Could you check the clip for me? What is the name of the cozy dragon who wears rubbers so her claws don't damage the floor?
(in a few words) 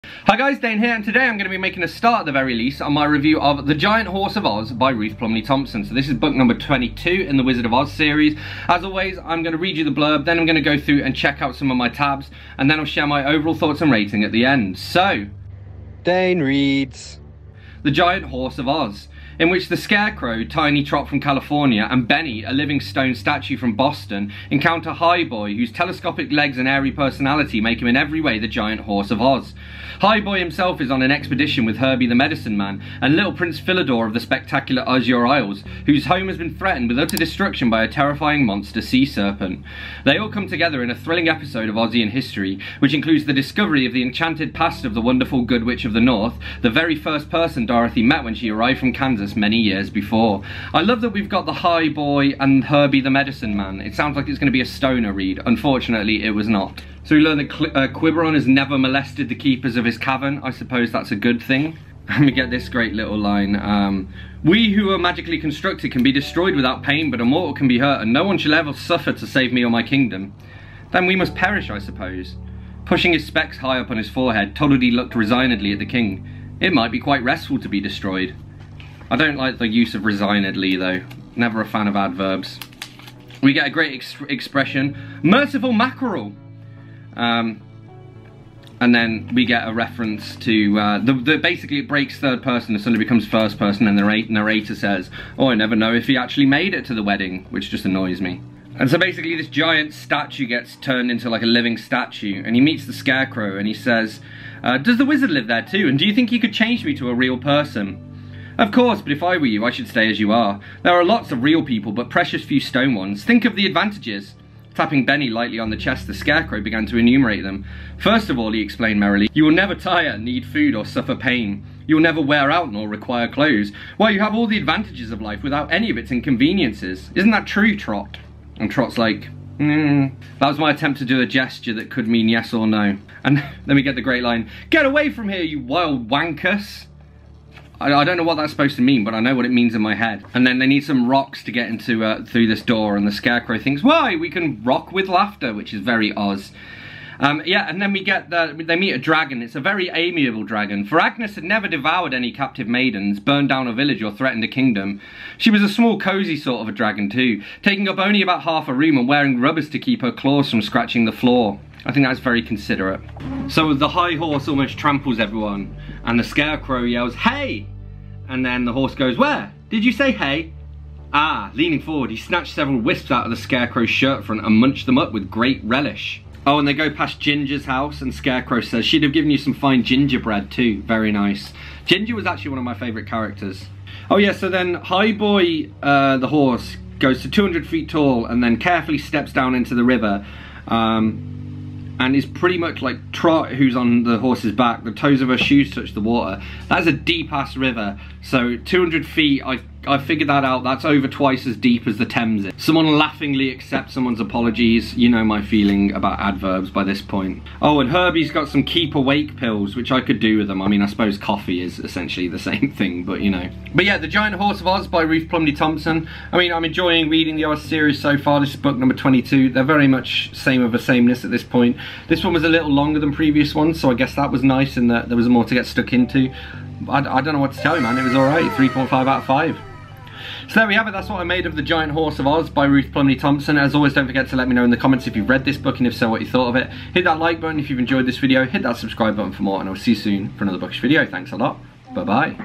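Agnes.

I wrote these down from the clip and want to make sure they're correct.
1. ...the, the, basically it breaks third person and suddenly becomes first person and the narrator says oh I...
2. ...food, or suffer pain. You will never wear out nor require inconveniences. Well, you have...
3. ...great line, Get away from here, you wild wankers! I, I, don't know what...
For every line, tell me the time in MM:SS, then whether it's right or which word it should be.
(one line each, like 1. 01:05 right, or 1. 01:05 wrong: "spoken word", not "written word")
1. 01:31 right
2. 02:00 wrong: "clothes", not "inconveniences"
3. 02:14 right.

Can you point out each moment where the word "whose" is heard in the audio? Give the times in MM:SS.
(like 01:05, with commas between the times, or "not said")
00:25, 00:35.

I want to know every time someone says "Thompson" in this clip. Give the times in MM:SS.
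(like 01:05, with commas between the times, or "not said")
00:05, 03:35, 03:53.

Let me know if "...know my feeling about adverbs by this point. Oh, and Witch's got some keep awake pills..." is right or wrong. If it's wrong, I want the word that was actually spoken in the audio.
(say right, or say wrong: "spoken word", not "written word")
wrong: "Herbie", not "Witch".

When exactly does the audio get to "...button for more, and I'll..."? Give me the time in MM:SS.
03:59.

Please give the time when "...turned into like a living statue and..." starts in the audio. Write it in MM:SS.
01:40.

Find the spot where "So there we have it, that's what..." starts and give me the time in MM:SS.
03:50.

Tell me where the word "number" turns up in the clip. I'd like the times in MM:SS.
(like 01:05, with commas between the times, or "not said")
00:06, 03:38.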